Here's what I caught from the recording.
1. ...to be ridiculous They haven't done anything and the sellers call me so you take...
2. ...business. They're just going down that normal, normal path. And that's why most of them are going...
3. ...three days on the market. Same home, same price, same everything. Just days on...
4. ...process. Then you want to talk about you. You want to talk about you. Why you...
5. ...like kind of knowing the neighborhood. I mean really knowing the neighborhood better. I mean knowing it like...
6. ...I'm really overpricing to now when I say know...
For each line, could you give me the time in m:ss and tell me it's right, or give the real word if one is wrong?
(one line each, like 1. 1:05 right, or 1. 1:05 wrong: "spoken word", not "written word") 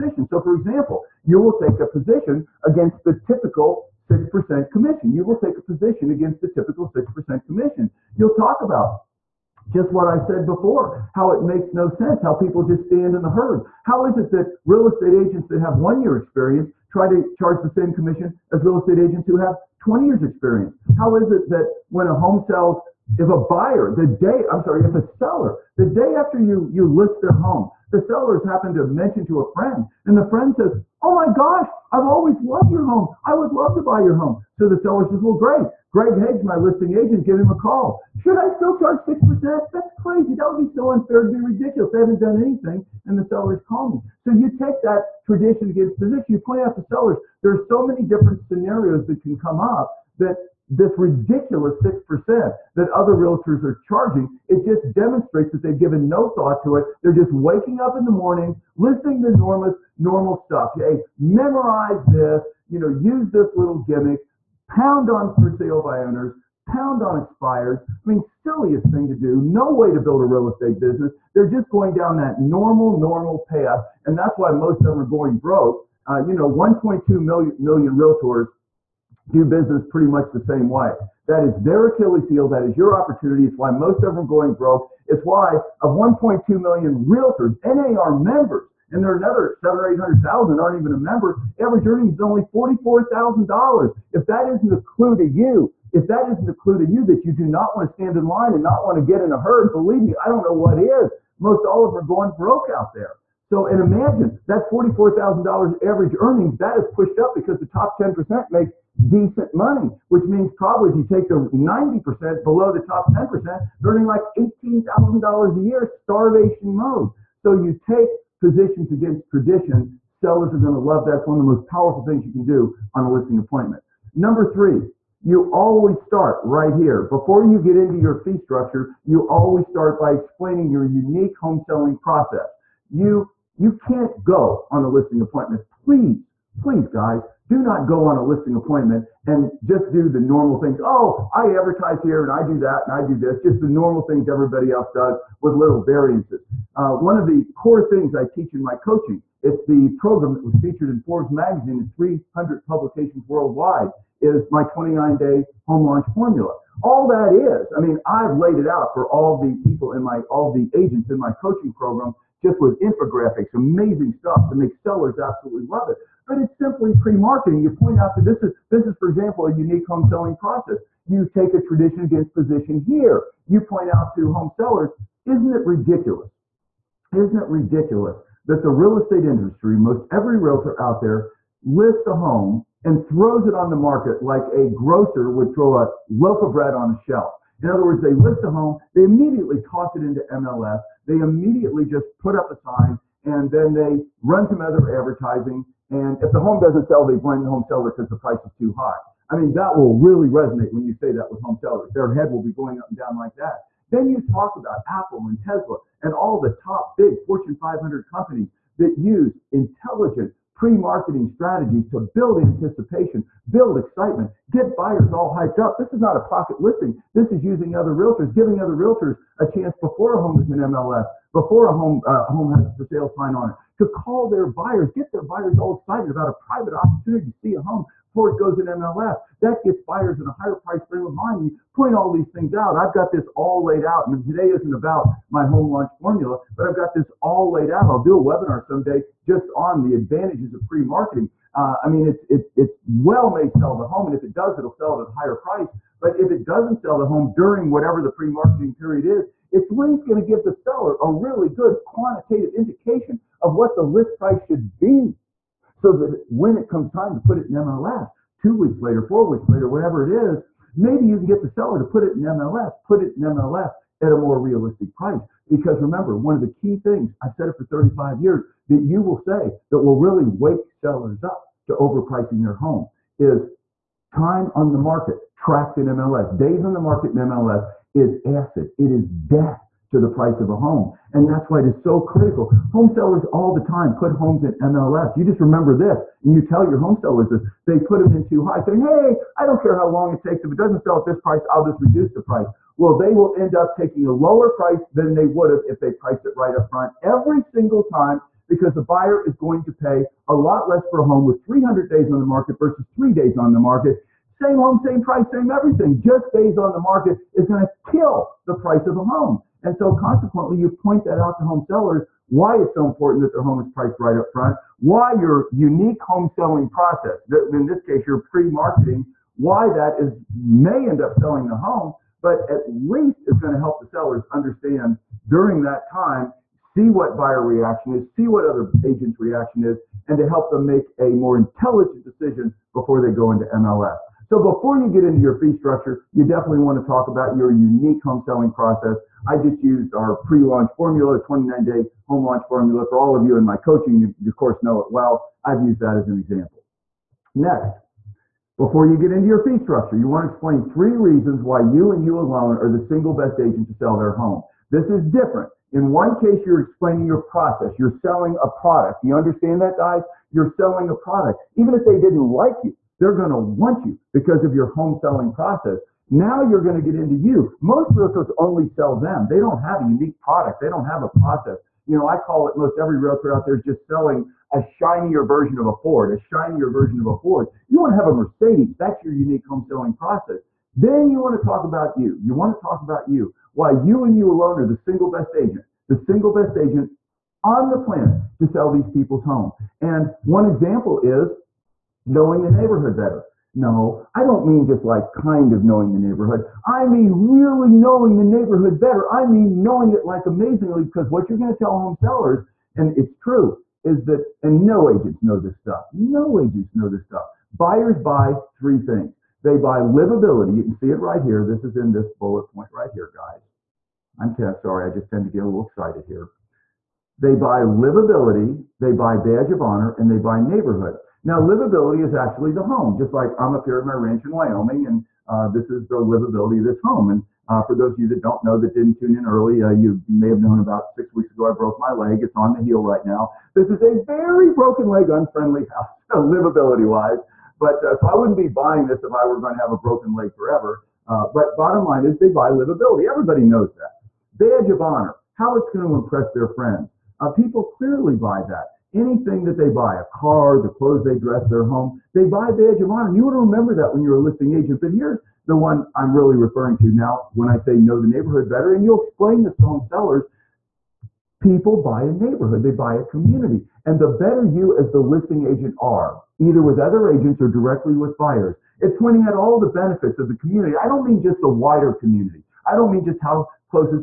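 1. 0:41 right
2. 1:10 right
3. 5:02 right
4. 6:19 right
5. 6:34 right
6. 7:35 wrong: "referring", not "overpricing".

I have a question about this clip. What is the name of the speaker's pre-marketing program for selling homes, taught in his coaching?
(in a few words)
29 day home launch formula.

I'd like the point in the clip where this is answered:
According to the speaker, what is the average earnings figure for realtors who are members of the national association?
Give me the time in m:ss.
1:31.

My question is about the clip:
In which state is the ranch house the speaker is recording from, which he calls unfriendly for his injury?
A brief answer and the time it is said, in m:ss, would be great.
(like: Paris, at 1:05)
Wyoming, at 7:04.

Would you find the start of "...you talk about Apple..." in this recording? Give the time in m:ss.
3:24.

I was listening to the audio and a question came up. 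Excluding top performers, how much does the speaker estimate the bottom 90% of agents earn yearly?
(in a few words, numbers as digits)
$18,000.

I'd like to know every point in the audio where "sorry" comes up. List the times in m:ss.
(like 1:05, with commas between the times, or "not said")
0:24, 6:54.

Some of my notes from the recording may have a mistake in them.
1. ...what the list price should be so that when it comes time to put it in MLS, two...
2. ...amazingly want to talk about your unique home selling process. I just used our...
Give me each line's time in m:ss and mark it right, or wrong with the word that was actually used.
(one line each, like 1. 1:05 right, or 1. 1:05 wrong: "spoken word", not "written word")
1. 4:13 right
2. 5:36 wrong: "definitely", not "amazingly".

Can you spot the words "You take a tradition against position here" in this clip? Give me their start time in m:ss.
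2:51.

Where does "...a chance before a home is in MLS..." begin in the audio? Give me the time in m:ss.
3:39.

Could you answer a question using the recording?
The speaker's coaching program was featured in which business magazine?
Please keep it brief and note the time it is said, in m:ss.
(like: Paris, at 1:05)
Forbes, at 2:31.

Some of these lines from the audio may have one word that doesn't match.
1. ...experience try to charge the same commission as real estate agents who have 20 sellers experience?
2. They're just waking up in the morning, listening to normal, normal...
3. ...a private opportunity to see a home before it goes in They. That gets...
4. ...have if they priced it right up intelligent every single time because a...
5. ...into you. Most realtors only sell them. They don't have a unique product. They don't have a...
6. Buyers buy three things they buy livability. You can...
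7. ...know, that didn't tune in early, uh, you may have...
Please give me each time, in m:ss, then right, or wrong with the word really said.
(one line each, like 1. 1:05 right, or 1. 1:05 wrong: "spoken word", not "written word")
1. 0:16 wrong: "years", not "sellers"
2. 0:57 right
3. 3:46 wrong: "MLS", not "They"
4. 4:55 wrong: "front", not "intelligent"
5. 6:06 right
6. 6:47 right
7. 7:08 right.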